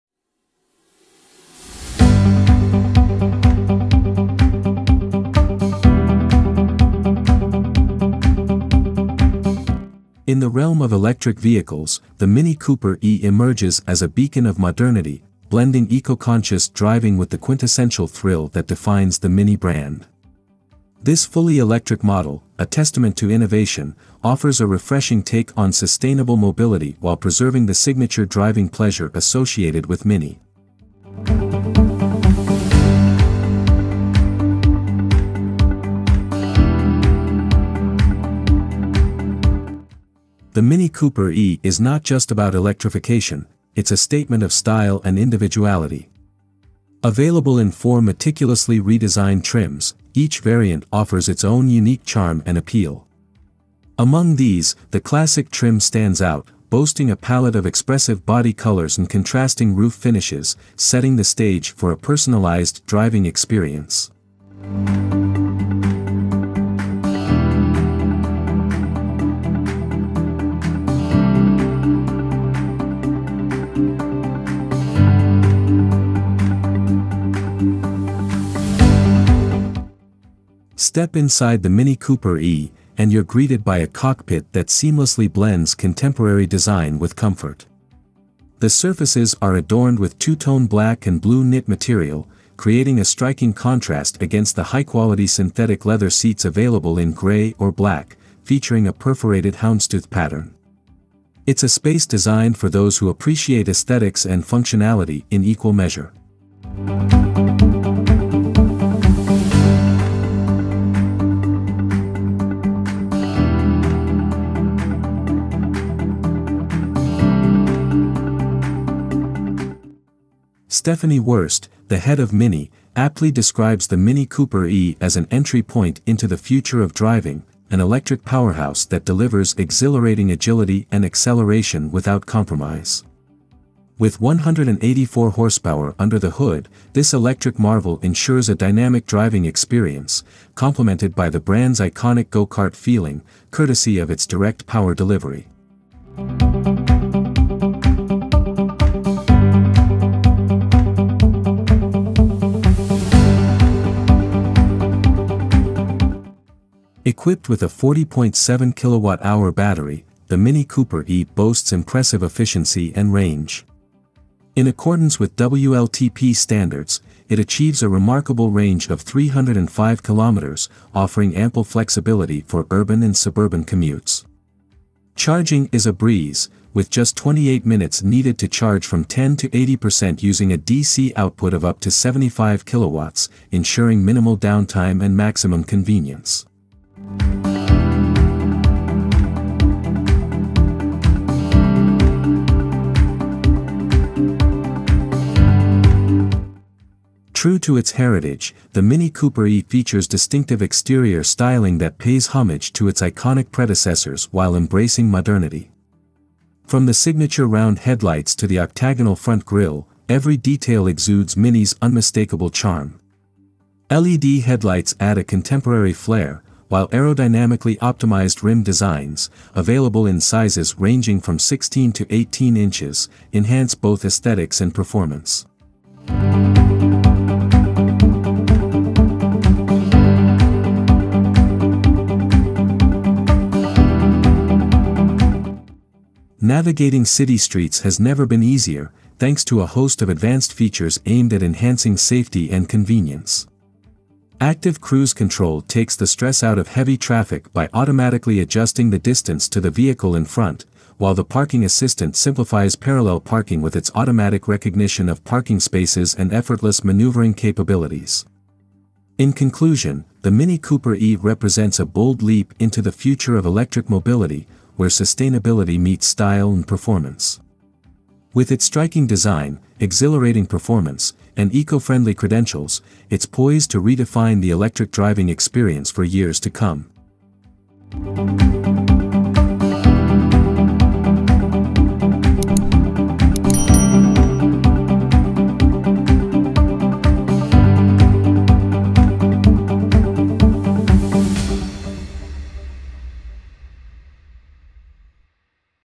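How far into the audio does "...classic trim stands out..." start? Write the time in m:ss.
0:54.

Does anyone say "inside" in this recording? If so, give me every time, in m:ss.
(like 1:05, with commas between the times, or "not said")
1:21.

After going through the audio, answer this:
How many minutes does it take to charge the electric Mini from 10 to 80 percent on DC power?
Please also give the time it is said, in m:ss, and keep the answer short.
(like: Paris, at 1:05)
28 minutes, at 2:57.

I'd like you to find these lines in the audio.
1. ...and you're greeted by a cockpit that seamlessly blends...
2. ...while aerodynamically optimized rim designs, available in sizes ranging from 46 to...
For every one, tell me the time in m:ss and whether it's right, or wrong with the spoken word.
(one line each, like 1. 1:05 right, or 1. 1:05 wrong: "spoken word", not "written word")
1. 1:22 right
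2. 3:36 wrong: "16", not "46".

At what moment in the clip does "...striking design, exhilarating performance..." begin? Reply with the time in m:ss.
4:28.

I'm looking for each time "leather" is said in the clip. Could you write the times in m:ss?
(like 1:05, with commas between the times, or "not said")
1:35.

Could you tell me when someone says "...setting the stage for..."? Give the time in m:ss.
1:00.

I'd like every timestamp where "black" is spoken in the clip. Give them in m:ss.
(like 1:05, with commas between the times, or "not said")
1:30, 1:37.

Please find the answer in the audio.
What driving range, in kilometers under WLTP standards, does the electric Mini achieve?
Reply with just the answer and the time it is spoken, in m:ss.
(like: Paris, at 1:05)
305 kilometers, at 2:49.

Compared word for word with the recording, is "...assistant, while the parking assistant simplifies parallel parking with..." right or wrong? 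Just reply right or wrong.
wrong.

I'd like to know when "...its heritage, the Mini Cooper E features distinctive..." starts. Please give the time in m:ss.
3:17.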